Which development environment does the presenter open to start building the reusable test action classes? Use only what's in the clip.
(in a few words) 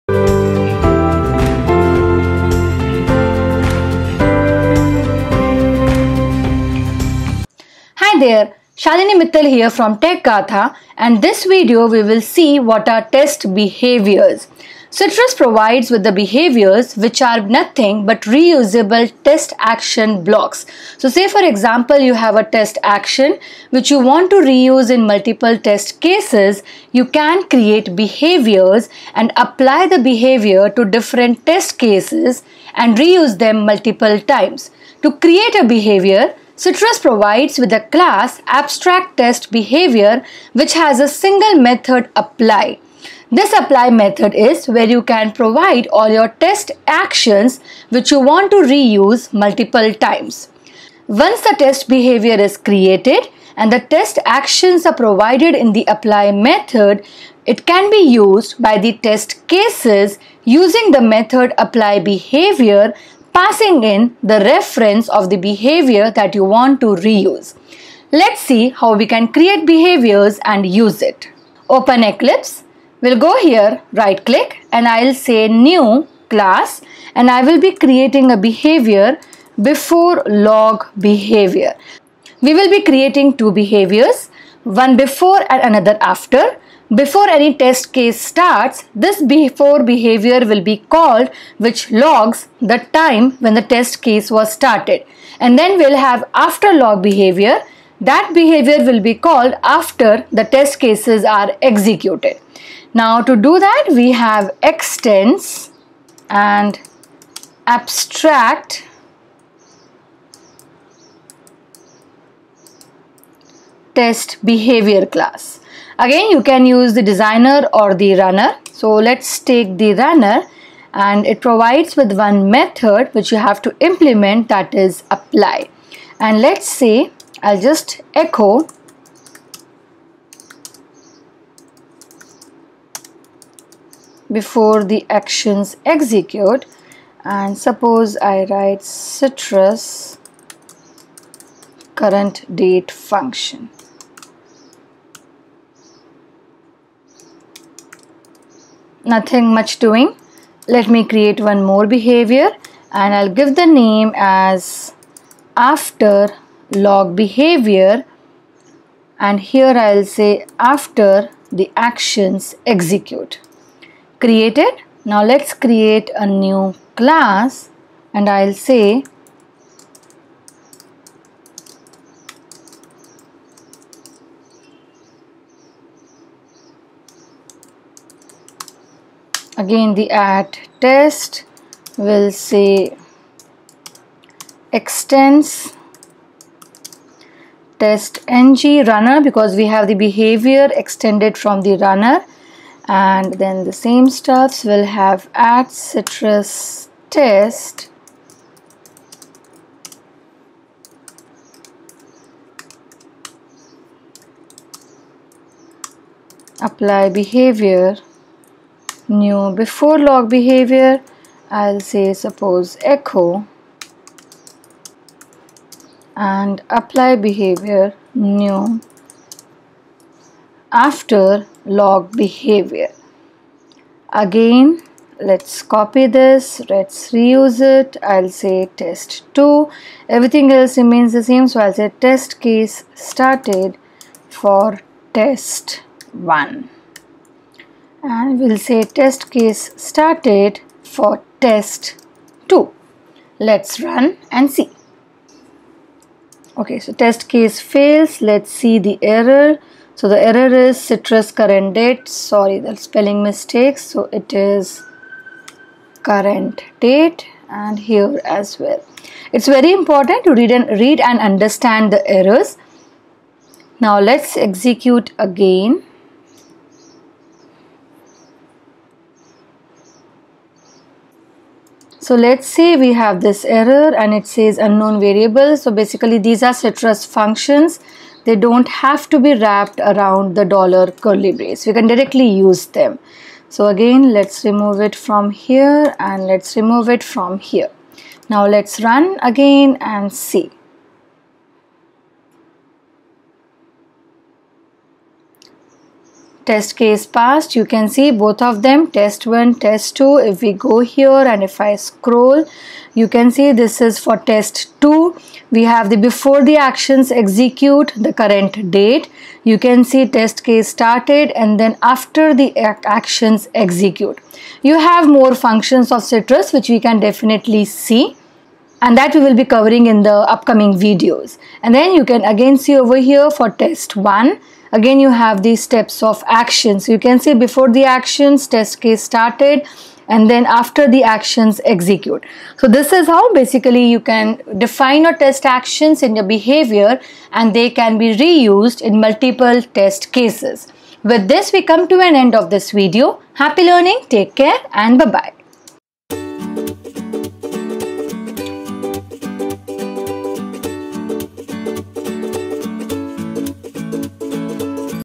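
Eclipse.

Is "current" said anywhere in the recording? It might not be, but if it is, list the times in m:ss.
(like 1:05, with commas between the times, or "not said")
2:21, 4:11, 4:16, 5:08.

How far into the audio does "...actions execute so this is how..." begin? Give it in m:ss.
5:31.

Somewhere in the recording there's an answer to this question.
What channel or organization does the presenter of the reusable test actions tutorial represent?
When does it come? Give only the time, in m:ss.
0:09.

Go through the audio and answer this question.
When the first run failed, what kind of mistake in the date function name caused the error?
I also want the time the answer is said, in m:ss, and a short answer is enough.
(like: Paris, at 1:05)
spelling mistake, at 4:12.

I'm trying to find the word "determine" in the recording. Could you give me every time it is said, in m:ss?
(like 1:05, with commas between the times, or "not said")
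not said.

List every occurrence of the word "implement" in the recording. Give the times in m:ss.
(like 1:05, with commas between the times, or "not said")
2:03.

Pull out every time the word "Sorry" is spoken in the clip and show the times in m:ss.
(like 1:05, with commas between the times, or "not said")
4:12.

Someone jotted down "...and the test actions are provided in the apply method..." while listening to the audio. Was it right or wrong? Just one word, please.
right.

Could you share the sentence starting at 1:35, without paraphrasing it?
And then we'll have after log behavior.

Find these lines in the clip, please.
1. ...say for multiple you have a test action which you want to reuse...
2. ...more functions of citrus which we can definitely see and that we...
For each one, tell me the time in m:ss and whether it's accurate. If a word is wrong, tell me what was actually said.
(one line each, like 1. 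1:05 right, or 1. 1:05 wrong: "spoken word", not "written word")
1. 0:21 wrong: "example", not "multiple"
2. 5:15 right.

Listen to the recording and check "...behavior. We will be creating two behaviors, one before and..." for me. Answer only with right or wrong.
right.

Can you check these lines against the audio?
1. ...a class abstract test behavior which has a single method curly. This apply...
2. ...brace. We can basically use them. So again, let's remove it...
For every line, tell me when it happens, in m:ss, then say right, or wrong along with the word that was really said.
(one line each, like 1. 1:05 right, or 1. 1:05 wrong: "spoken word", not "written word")
1. 0:37 wrong: "apply", not "curly"
2. 4:41 wrong: "directly", not "basically".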